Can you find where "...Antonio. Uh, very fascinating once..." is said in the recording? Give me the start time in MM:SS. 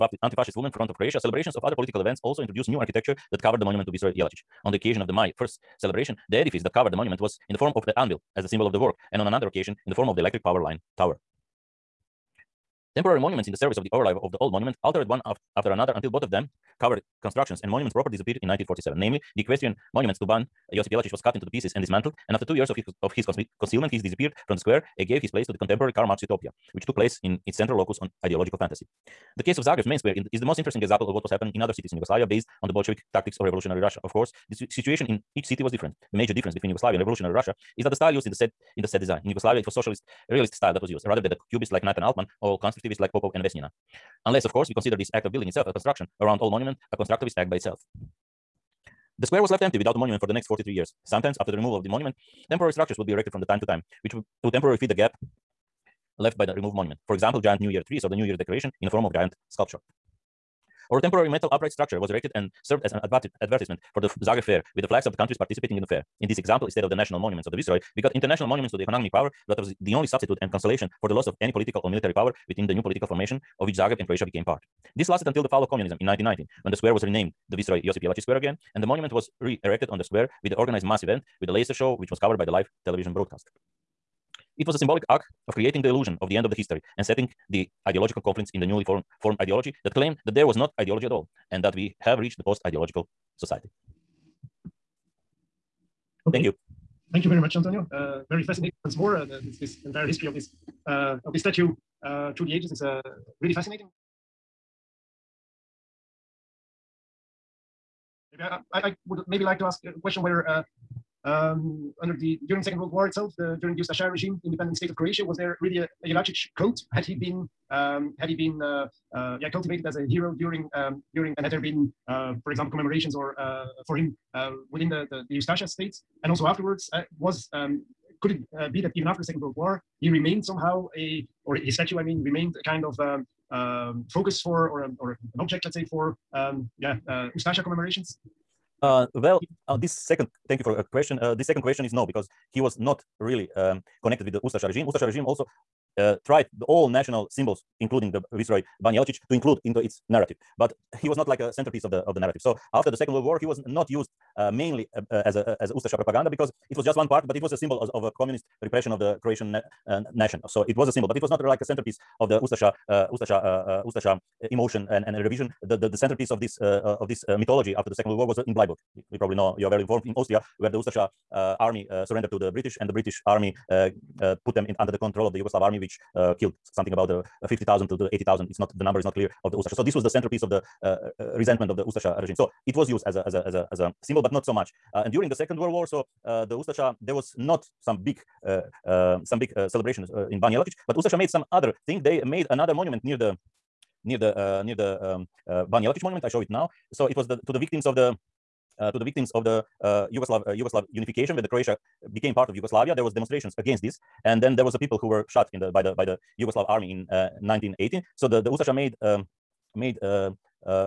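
01:37.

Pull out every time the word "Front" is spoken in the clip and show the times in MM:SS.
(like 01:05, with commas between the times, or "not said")
00:00.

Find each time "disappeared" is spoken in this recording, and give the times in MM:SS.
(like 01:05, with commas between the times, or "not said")
00:18, 00:23.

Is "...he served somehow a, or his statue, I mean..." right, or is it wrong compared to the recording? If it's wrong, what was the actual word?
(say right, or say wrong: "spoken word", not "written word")
wrong: "remained", not "served".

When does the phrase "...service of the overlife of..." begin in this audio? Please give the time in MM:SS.
00:13.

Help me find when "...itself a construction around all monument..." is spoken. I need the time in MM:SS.
00:45.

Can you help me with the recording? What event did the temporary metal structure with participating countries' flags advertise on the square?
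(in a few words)
Zagreb Fair.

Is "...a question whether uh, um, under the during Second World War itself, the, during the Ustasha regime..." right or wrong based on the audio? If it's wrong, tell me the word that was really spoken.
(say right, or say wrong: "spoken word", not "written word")
right.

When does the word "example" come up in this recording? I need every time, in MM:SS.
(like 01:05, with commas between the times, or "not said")
00:30, 00:57, 01:06, 02:02.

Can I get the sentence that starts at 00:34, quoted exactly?
Of course, the situation in each city was different.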